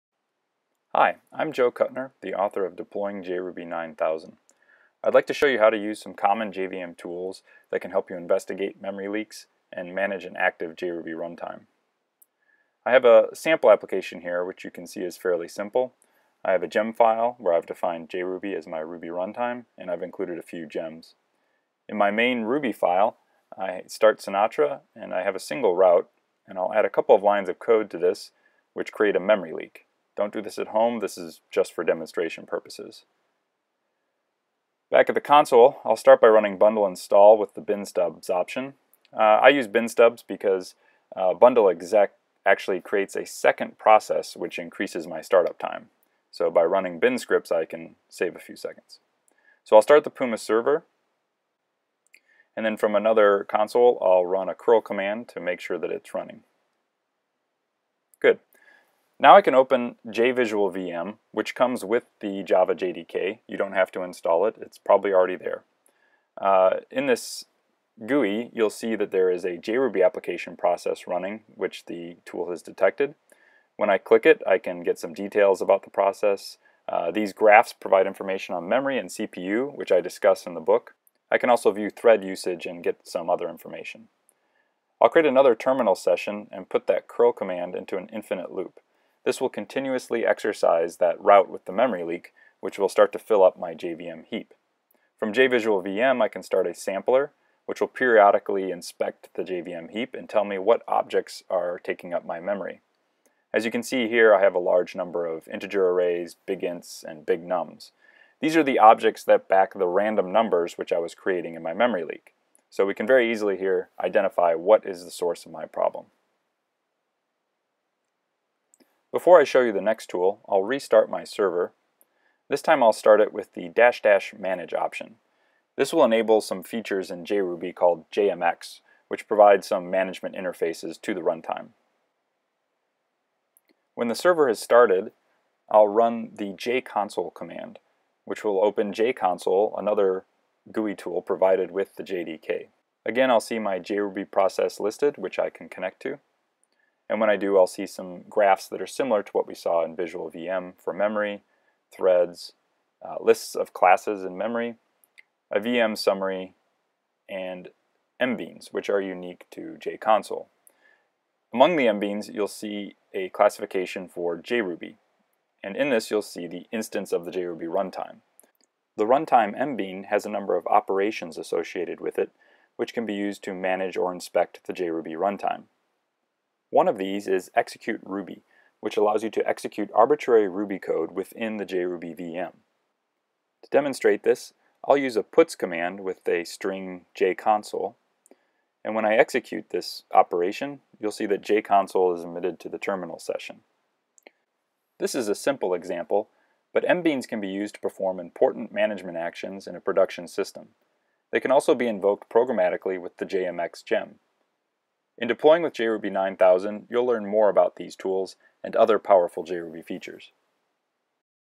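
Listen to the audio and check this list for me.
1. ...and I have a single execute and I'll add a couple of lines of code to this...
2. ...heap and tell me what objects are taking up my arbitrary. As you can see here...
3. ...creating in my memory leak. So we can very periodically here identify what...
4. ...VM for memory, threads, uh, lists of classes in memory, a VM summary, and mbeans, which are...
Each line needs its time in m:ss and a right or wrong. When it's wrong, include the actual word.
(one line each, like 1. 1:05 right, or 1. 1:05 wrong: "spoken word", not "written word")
1. 0:24 wrong: "route", not "execute"
2. 1:39 wrong: "memory", not "arbitrary"
3. 1:51 wrong: "easily", not "periodically"
4. 2:30 right.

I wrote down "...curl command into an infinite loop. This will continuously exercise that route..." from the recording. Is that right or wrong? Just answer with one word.
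right.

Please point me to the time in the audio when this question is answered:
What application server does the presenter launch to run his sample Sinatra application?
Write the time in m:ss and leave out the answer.
0:50.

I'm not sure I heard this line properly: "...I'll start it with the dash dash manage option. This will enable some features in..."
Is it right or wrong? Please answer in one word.
right.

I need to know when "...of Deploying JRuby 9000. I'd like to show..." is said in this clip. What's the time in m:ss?
0:02.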